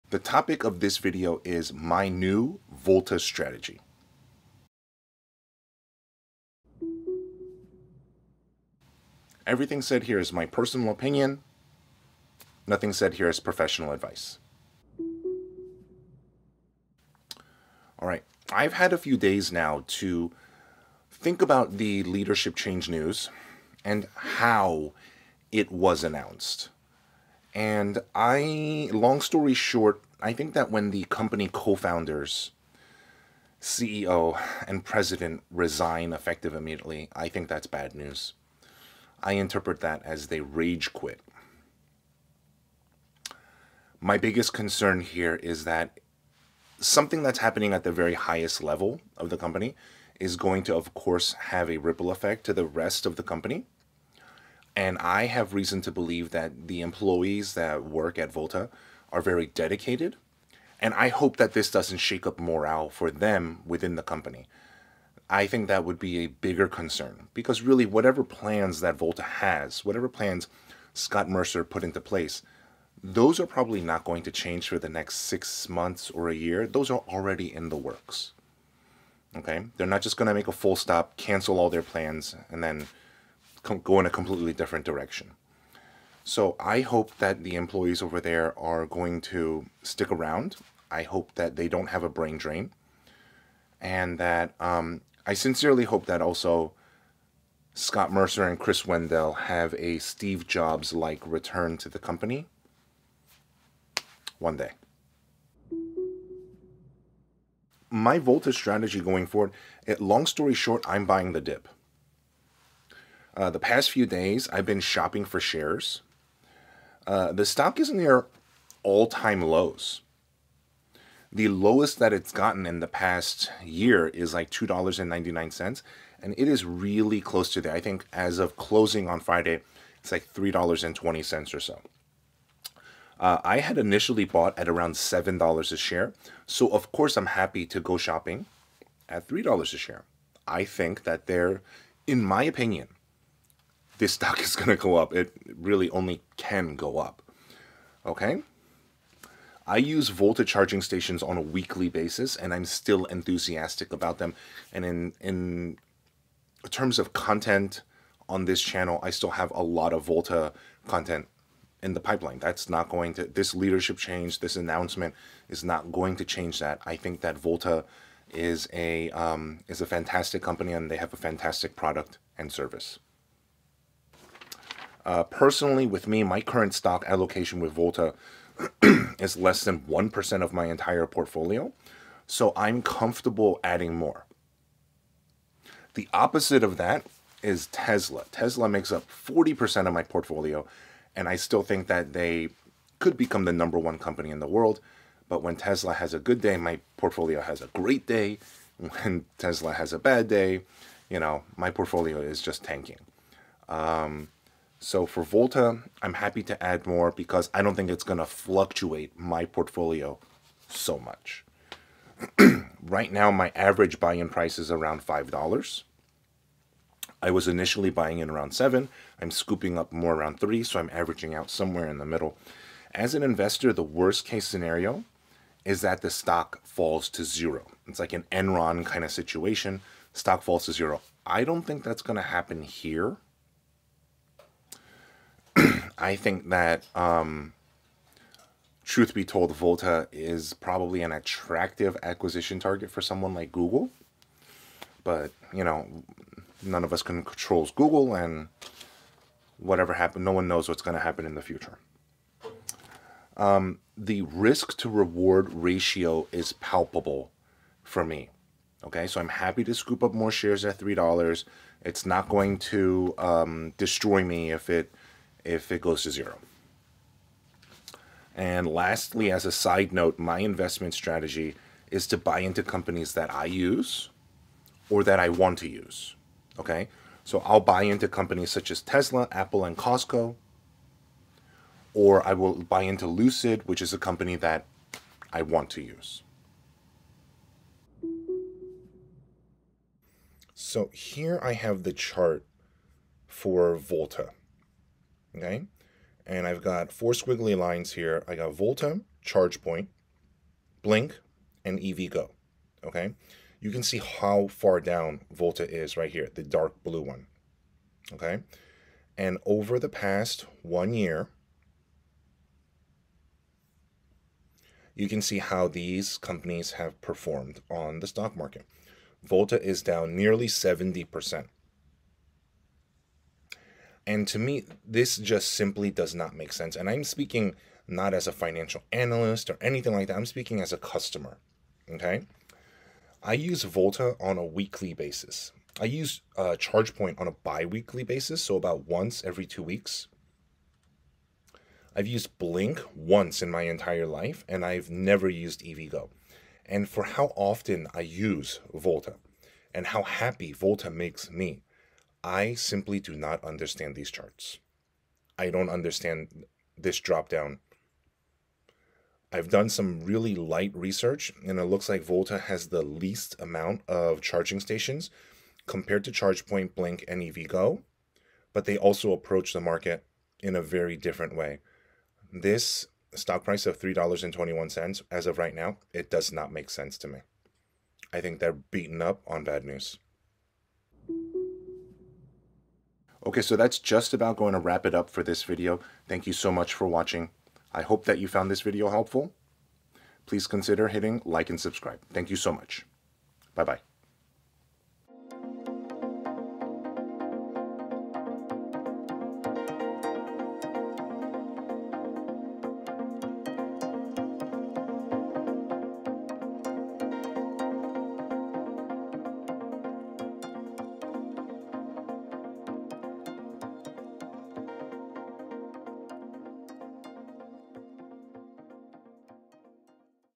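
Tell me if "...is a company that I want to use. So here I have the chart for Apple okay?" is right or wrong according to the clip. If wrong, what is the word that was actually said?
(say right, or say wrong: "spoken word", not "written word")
wrong: "Volta", not "Apple".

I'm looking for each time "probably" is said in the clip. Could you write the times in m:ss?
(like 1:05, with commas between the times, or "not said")
1:13, 4:00.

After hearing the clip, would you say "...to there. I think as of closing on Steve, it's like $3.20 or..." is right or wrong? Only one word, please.
wrong.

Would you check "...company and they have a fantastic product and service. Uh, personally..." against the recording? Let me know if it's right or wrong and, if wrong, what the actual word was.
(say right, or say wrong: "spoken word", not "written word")
right.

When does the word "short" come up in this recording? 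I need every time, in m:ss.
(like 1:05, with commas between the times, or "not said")
0:29, 1:50.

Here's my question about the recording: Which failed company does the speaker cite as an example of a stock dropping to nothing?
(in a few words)
Enron.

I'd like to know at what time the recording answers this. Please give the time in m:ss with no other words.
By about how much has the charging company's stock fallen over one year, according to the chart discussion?
5:20.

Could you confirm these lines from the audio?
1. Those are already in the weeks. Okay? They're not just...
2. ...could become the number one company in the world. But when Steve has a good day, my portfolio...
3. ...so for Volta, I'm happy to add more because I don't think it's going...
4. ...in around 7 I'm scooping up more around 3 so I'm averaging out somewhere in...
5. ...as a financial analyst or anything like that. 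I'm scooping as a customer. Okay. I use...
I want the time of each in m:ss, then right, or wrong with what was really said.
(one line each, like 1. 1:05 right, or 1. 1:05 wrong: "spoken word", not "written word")
1. 1:16 wrong: "works", not "weeks"
2. 3:12 wrong: "Tesla", not "Steve"
3. 3:24 right
4. 3:38 right
5. 5:28 wrong: "speaking", not "scooping".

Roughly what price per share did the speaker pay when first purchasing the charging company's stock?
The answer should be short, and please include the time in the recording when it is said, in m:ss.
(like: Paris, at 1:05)
$7, at 2:14.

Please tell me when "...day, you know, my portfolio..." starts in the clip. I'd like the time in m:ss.
3:20.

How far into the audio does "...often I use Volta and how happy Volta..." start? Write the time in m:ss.
5:47.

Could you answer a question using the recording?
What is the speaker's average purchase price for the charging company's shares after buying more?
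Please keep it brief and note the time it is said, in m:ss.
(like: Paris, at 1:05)
$5, at 3:34.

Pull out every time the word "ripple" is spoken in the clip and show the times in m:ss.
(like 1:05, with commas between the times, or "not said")
0:51.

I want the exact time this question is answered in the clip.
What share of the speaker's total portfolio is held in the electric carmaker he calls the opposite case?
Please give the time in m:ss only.
3:09.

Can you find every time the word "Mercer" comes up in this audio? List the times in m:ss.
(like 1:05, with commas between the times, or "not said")
1:11, 1:38.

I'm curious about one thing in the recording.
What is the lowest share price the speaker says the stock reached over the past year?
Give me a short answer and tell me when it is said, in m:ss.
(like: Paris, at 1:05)
$2.99, at 2:04.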